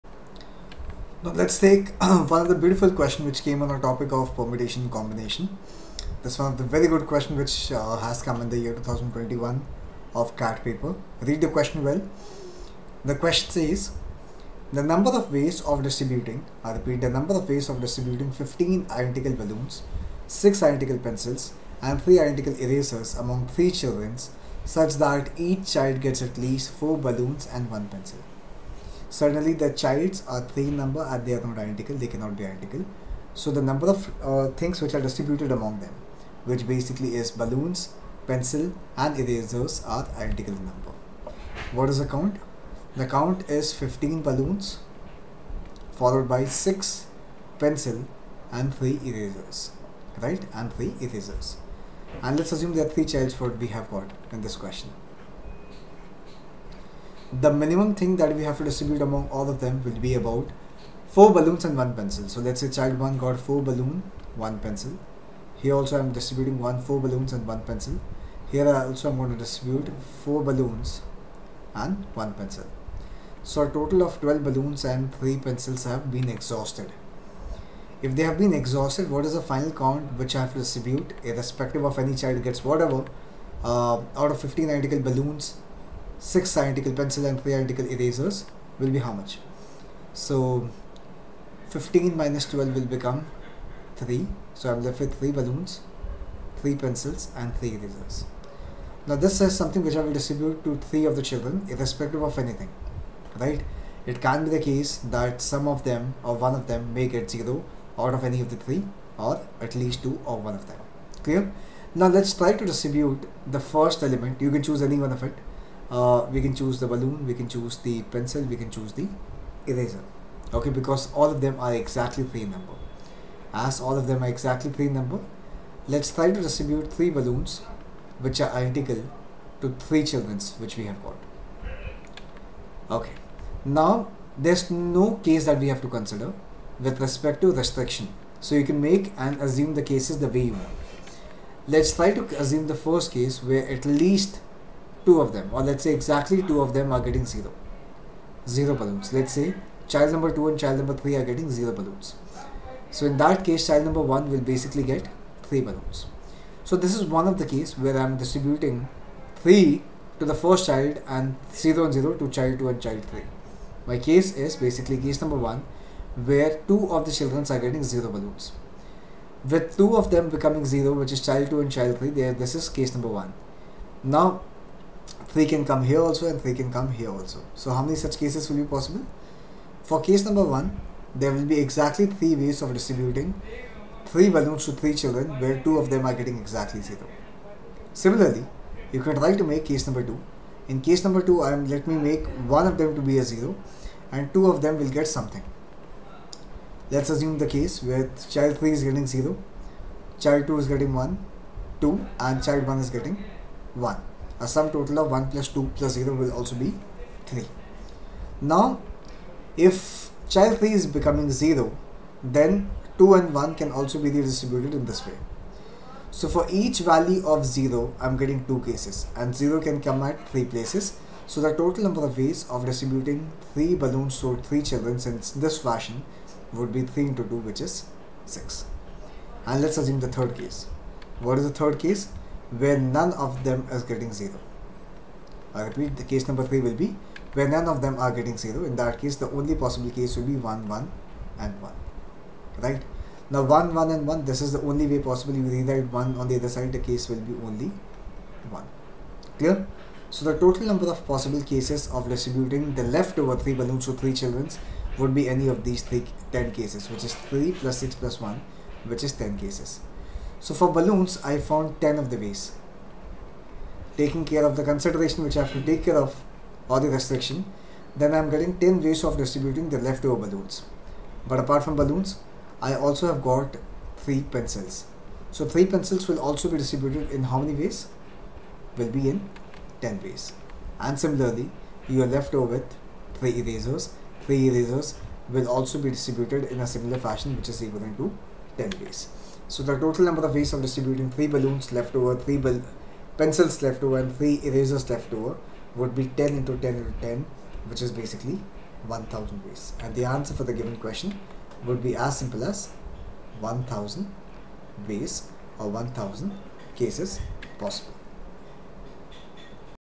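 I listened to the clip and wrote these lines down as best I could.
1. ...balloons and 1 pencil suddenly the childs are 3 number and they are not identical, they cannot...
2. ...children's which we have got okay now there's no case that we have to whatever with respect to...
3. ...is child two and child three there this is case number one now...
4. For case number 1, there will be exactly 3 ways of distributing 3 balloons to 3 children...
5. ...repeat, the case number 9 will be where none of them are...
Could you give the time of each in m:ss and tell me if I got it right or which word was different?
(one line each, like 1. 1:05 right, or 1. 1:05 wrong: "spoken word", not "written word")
1. 0:26 right
2. 2:10 wrong: "consider", not "whatever"
3. 2:51 right
4. 2:59 right
5. 3:55 wrong: "3", not "9".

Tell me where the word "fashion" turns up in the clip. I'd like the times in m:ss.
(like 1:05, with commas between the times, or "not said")
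3:45, 4:46.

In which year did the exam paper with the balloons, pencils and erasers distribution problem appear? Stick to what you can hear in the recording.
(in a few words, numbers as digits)
2021.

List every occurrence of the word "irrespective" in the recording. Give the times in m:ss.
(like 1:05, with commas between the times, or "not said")
1:21, 1:41.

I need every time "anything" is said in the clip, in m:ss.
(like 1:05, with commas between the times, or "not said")
1:42.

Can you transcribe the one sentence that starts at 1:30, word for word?
So 15 minus 12 will become 3.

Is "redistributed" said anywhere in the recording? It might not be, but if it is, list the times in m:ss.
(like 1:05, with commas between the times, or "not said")
3:34.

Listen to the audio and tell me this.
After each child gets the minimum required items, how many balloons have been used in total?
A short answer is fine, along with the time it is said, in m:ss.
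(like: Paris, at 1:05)
12, at 1:14.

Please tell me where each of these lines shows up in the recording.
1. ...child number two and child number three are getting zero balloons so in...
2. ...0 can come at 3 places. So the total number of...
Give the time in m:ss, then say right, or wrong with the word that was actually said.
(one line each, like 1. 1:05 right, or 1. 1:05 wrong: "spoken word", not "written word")
1. 2:29 right
2. 3:39 right.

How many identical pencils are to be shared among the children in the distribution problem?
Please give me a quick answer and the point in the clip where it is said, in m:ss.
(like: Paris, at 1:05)
6, at 0:20.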